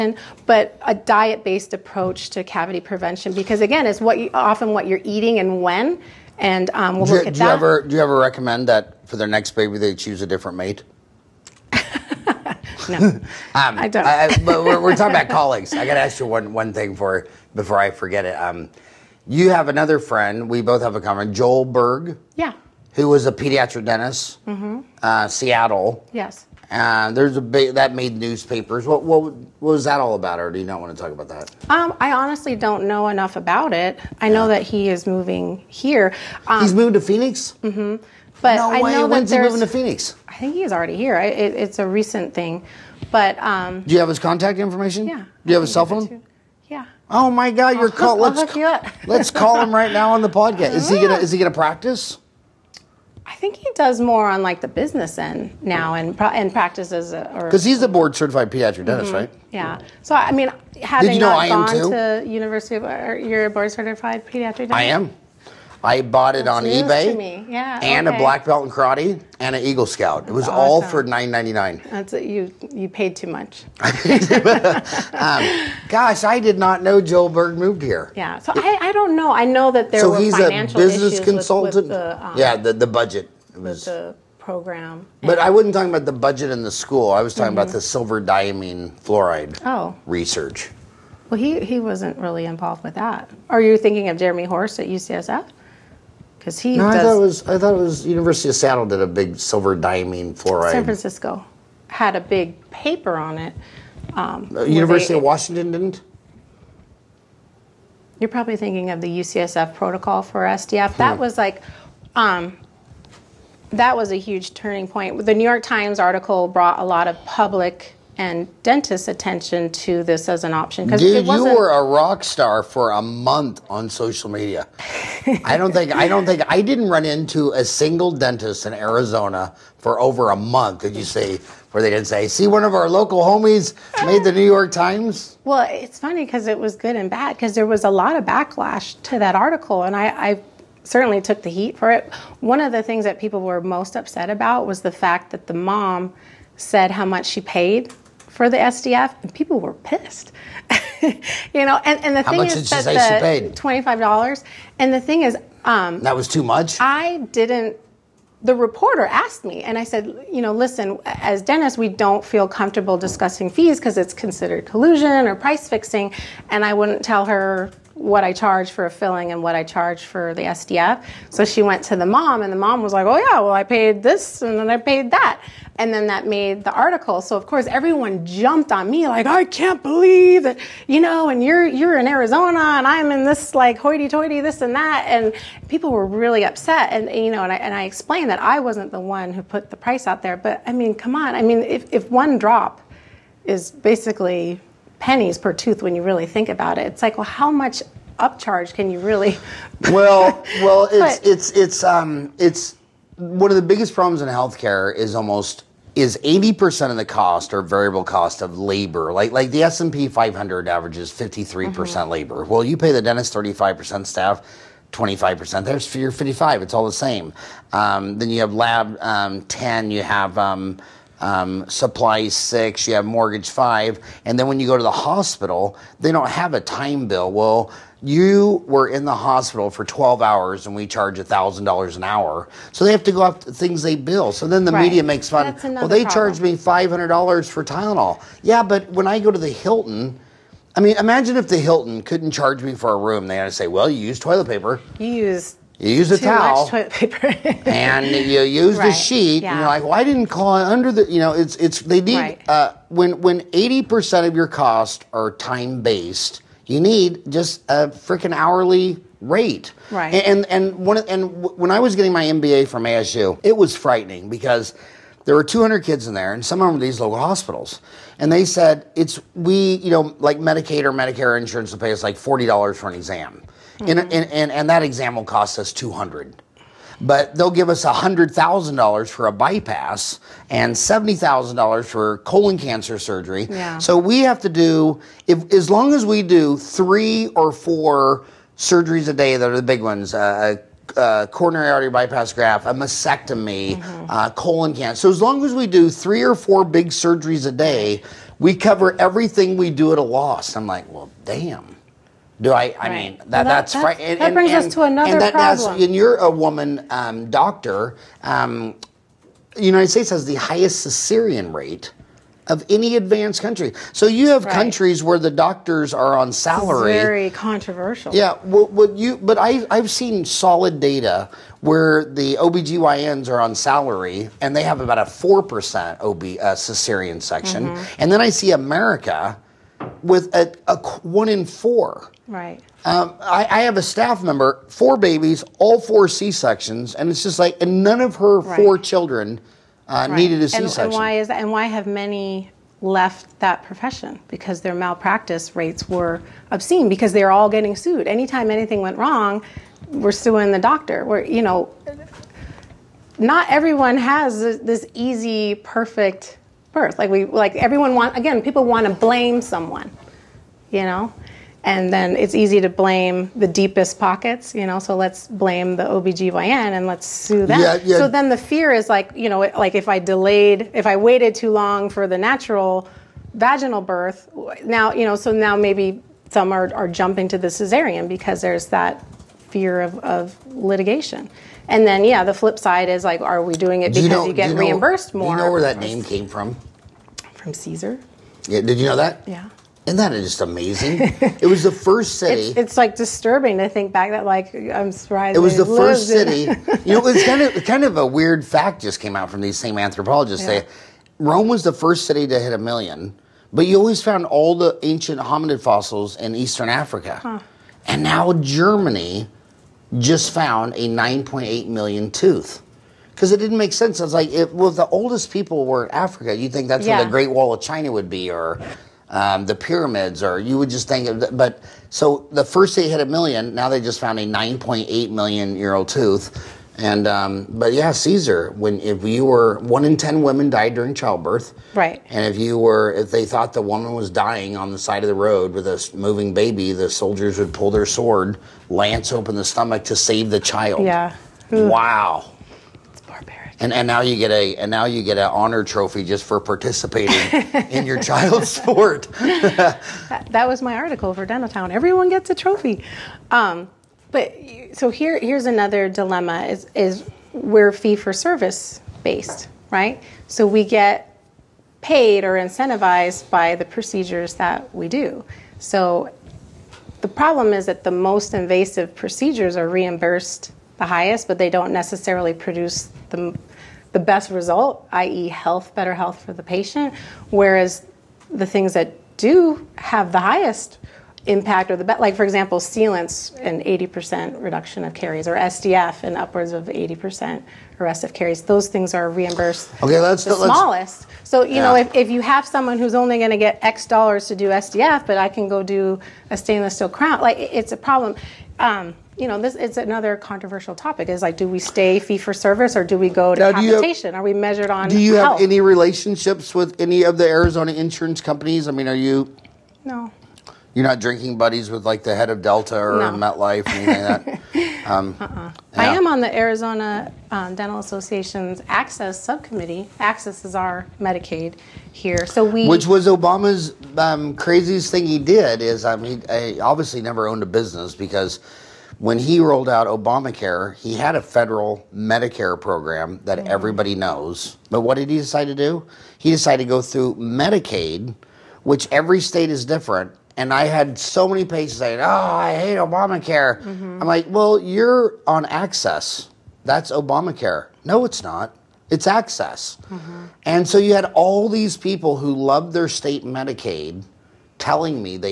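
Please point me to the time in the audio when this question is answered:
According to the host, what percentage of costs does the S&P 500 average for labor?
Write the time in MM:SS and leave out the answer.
03:31.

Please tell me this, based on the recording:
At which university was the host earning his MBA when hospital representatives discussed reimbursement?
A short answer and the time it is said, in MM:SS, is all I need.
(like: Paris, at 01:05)
ASU, at 04:22.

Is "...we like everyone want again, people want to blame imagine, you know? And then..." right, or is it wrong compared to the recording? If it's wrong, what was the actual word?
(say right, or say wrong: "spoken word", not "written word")
wrong: "someone", not "imagine".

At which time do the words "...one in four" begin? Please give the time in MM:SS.
05:31.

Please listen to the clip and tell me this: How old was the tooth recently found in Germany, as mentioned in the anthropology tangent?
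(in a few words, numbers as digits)
9.8 million years.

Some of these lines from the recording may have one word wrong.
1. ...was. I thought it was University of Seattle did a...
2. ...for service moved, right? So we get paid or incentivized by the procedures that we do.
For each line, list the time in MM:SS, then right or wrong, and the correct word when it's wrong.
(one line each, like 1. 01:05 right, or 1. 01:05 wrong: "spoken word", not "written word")
1. 01:37 right
2. 07:37 wrong: "based", not "moved".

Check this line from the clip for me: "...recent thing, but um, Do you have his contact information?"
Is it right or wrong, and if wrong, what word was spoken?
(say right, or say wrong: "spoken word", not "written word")
right.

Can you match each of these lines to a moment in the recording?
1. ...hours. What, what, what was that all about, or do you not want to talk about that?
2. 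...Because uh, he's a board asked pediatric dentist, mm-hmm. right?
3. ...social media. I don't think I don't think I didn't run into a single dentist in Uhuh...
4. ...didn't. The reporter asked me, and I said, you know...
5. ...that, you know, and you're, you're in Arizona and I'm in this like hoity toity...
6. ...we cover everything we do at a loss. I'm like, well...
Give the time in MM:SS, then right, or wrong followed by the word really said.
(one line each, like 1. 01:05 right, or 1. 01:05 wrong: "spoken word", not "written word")
1. 00:28 wrong: "newspapers", not "hours"
2. 00:57 wrong: "certified", not "asked"
3. 02:03 wrong: "Arizona", not "Uhuh"
4. 02:37 right
5. 03:00 right
6. 04:58 right.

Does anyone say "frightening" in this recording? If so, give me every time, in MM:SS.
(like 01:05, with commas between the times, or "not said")
04:23.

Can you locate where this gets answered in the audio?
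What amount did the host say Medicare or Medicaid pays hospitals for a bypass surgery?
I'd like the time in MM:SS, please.
04:37.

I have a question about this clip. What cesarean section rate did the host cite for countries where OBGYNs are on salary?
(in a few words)
4%.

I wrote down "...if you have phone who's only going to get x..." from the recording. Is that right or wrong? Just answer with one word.
wrong.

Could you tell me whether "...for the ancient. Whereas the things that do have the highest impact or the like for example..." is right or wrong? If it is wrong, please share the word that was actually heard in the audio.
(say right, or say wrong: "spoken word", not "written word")
wrong: "patient", not "ancient".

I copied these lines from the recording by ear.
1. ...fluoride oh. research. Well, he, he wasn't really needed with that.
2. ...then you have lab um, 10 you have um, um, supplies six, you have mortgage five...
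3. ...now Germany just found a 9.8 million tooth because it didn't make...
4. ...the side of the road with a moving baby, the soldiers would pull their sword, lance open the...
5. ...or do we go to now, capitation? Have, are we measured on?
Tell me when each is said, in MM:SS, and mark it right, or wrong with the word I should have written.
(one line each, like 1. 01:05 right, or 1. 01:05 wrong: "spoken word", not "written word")
1. 01:29 wrong: "involved", not "needed"
2. 03:38 right
3. 06:48 right
4. 07:14 right
5. 08:22 right.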